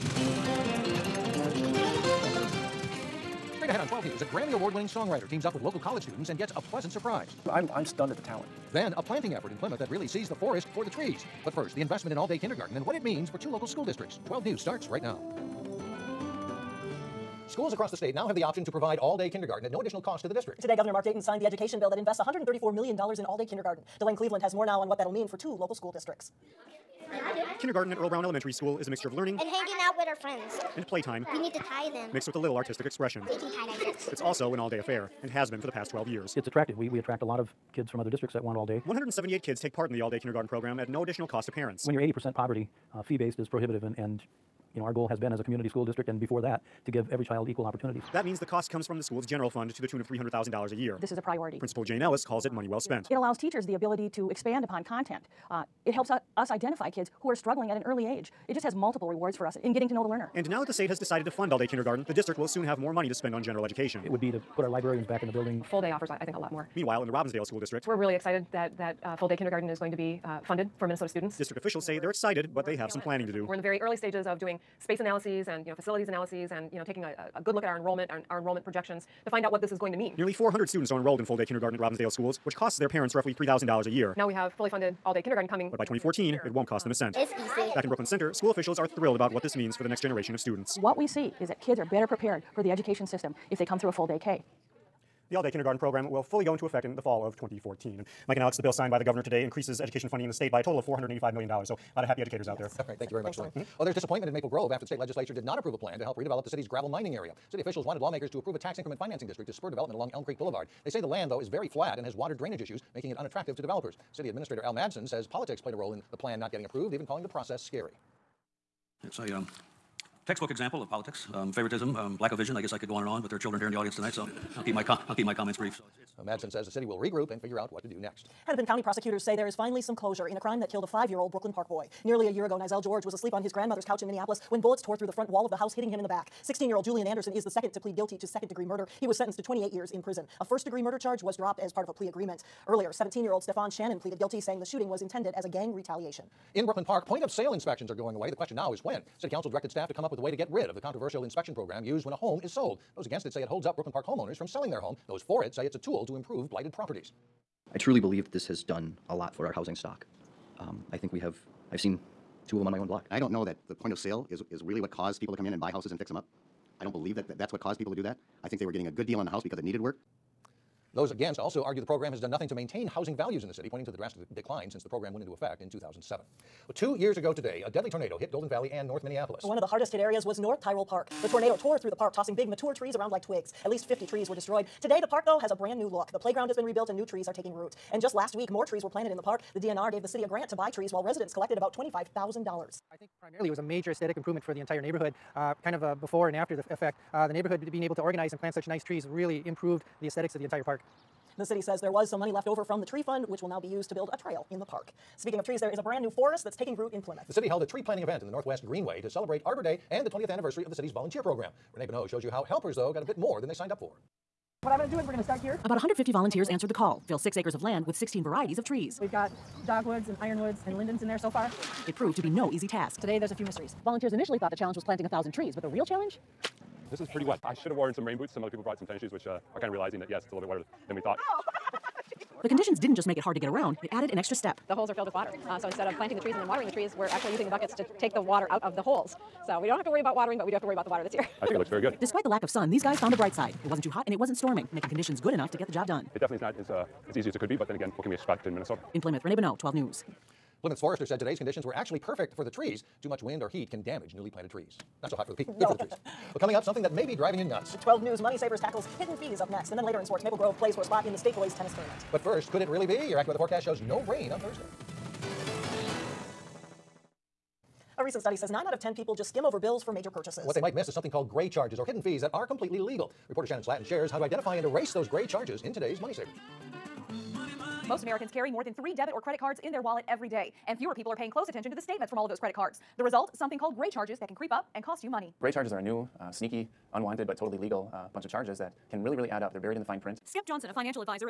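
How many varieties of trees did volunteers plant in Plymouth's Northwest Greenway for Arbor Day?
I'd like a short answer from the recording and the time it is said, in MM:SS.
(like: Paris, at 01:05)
16, at 03:37.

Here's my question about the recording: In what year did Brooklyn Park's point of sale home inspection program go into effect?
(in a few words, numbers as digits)
2007.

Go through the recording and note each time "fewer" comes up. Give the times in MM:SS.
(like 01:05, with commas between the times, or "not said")
04:40.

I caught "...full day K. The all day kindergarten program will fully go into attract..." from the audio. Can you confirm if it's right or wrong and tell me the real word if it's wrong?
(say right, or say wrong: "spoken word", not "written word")
wrong: "effect", not "attract".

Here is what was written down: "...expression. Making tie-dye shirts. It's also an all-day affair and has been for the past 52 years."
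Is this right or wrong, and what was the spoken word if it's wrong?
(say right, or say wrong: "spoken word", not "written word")
wrong: "12", not "52".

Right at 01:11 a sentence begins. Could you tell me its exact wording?
District officials you know, say they're excited, but they have some planning to do.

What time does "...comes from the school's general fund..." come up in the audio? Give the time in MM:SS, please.
00:48.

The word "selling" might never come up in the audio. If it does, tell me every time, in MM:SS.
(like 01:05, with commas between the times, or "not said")
02:34.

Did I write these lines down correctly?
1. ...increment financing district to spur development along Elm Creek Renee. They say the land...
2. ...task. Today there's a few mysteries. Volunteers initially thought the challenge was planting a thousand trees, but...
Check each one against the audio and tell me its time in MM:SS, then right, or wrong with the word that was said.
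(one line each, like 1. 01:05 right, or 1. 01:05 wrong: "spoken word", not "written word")
1. 01:48 wrong: "Boulevard", not "Renee"
2. 03:42 right.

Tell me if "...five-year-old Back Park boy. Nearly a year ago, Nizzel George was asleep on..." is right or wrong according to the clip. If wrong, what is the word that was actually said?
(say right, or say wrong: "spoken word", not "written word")
wrong: "Brooklyn", not "Back".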